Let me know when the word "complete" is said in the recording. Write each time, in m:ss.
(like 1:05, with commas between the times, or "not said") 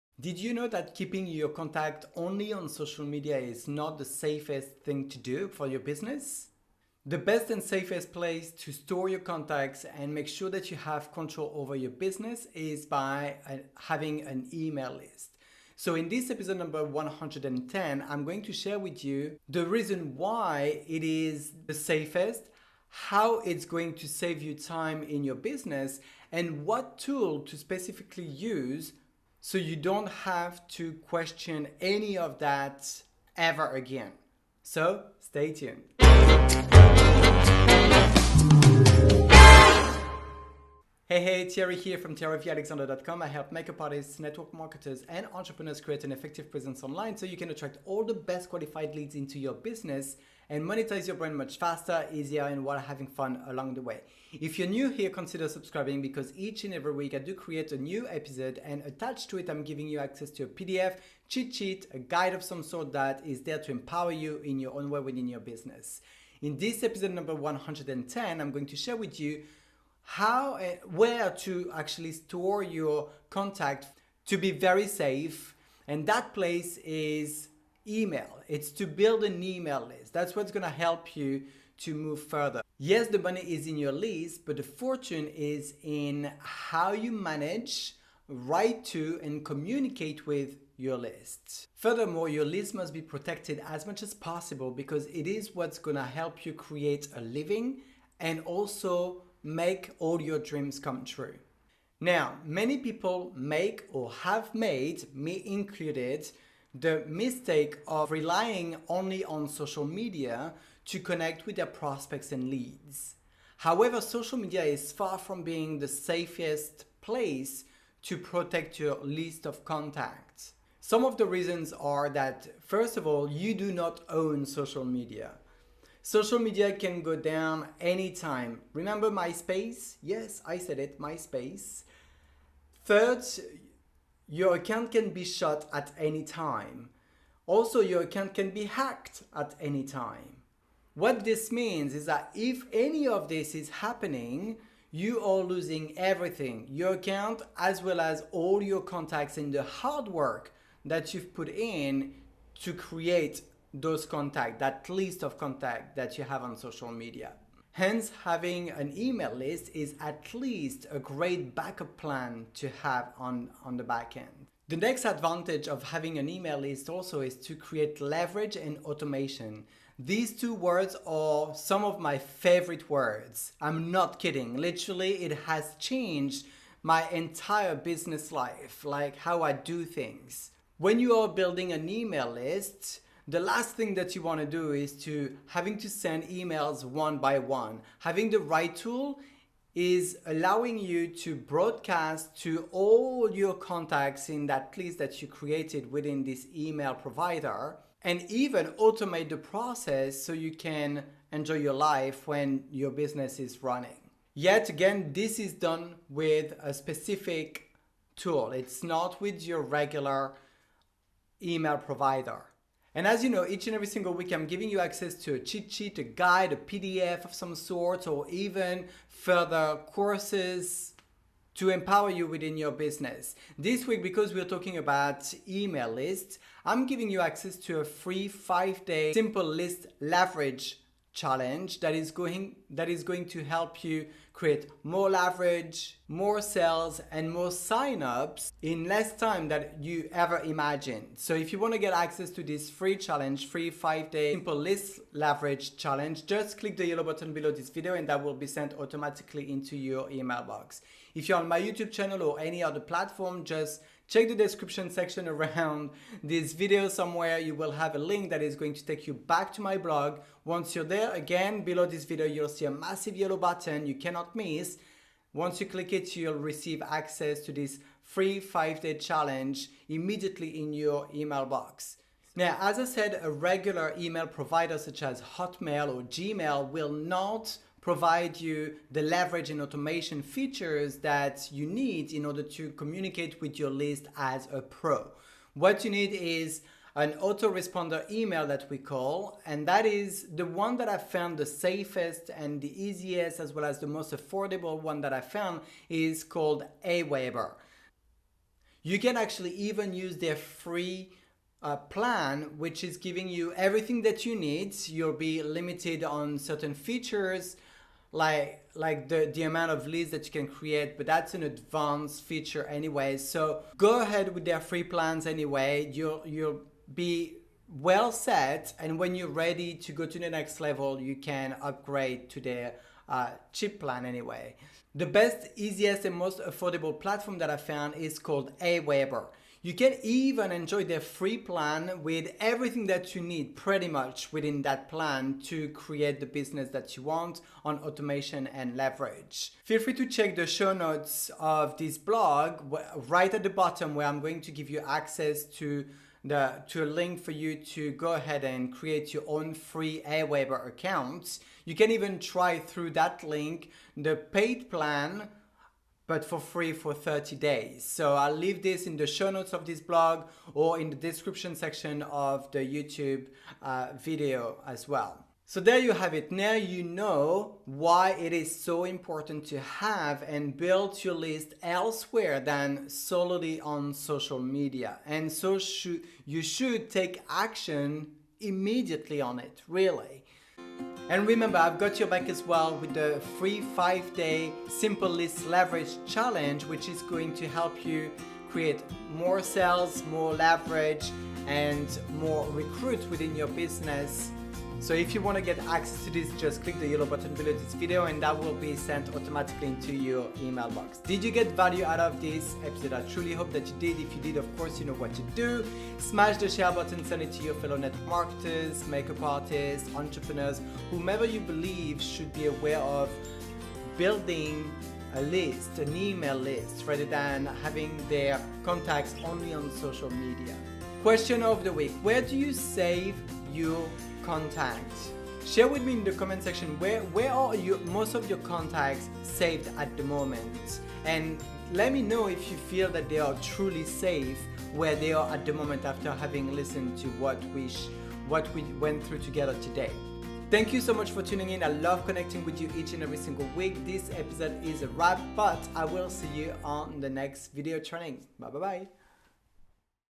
not said.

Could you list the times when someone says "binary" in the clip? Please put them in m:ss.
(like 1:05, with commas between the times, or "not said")
not said.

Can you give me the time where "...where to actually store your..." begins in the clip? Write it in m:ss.
1:10.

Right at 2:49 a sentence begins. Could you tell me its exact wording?
These two words are some of my favorite words.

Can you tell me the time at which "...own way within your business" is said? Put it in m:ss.
1:04.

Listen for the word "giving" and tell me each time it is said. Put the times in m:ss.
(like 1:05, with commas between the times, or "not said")
0:59, 3:34, 3:46, 5:02.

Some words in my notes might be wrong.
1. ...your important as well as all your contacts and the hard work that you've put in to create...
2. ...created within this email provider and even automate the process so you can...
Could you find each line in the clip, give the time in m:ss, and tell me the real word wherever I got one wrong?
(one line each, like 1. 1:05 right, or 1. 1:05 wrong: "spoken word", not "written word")
1. 2:26 wrong: "account", not "important"
2. 3:15 right.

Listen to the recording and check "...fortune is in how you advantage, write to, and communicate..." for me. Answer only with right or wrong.
wrong.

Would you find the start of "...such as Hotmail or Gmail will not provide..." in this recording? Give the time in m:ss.
4:34.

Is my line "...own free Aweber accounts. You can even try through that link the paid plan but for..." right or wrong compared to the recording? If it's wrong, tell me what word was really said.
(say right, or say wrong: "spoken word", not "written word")
right.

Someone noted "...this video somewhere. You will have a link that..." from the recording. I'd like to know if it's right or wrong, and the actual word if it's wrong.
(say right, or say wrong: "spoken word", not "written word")
right.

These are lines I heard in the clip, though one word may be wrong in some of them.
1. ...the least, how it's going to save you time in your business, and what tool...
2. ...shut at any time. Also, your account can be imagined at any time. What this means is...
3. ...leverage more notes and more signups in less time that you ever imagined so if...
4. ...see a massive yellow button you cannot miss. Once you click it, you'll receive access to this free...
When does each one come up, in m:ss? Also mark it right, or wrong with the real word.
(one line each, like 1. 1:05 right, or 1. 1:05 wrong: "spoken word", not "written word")
1. 0:21 wrong: "safest", not "least"
2. 2:15 wrong: "hacked", not "imagined"
3. 3:55 wrong: "sales", not "notes"
4. 4:22 right.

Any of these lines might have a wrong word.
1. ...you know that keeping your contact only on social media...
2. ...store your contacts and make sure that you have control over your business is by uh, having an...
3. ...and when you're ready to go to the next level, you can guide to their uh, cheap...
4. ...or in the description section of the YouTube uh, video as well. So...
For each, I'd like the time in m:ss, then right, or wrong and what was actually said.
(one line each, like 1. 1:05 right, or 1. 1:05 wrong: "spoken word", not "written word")
1. 0:00 right
2. 0:08 right
3. 5:18 wrong: "upgrade", not "guide"
4. 6:00 right.